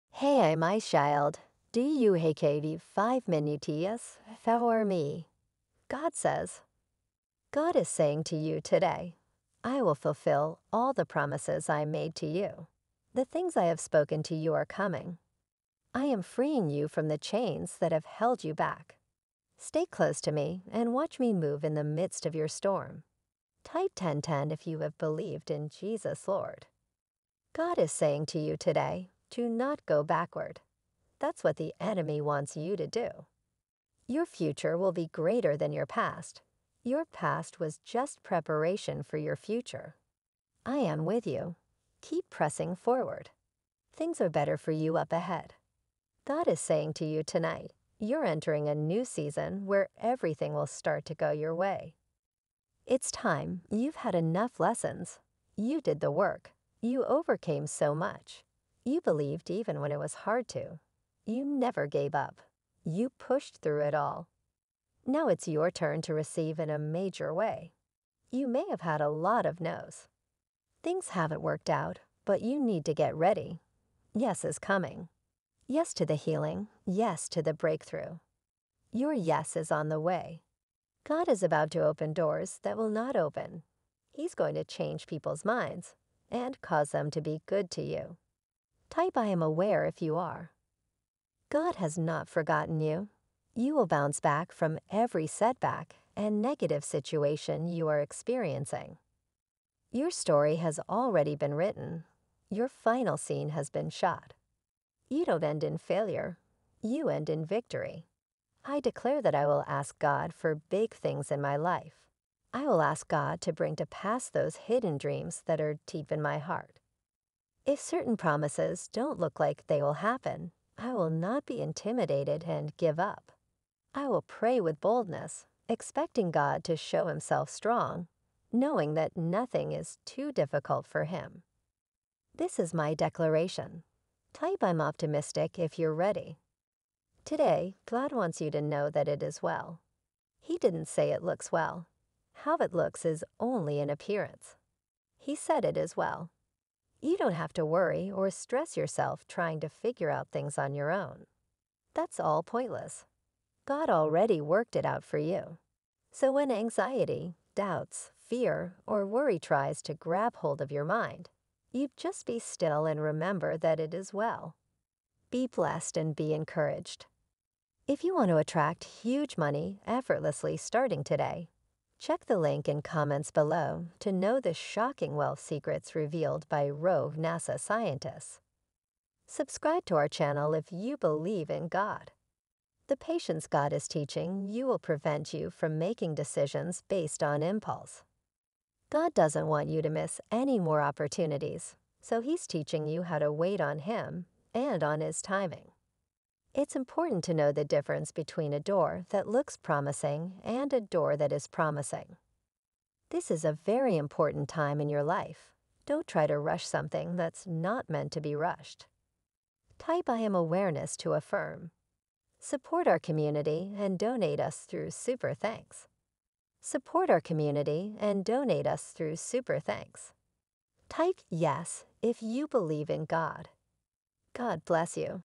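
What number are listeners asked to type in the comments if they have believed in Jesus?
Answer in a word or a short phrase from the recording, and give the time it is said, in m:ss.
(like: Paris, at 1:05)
1010, at 0:23.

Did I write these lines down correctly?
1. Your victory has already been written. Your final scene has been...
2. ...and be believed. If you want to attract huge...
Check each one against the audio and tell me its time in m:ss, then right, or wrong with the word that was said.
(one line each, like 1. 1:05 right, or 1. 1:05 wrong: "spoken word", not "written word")
1. 1:39 wrong: "story", not "victory"
2. 2:45 wrong: "encouraged", not "believed".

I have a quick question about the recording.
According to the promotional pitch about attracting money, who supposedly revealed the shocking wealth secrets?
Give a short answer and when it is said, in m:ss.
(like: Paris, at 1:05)
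rogue NASA scientists, at 2:56.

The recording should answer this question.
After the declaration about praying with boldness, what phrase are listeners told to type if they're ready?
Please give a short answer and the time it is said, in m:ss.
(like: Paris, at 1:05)
I'm optimistic, at 2:14.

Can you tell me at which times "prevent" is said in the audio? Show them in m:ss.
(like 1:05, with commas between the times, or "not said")
3:04.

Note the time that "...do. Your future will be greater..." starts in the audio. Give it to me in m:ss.
0:32.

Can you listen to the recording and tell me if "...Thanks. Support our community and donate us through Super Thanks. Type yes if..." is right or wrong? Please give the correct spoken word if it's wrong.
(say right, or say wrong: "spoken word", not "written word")
right.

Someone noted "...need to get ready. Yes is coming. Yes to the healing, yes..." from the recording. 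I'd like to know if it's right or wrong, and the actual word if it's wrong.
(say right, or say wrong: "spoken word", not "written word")
right.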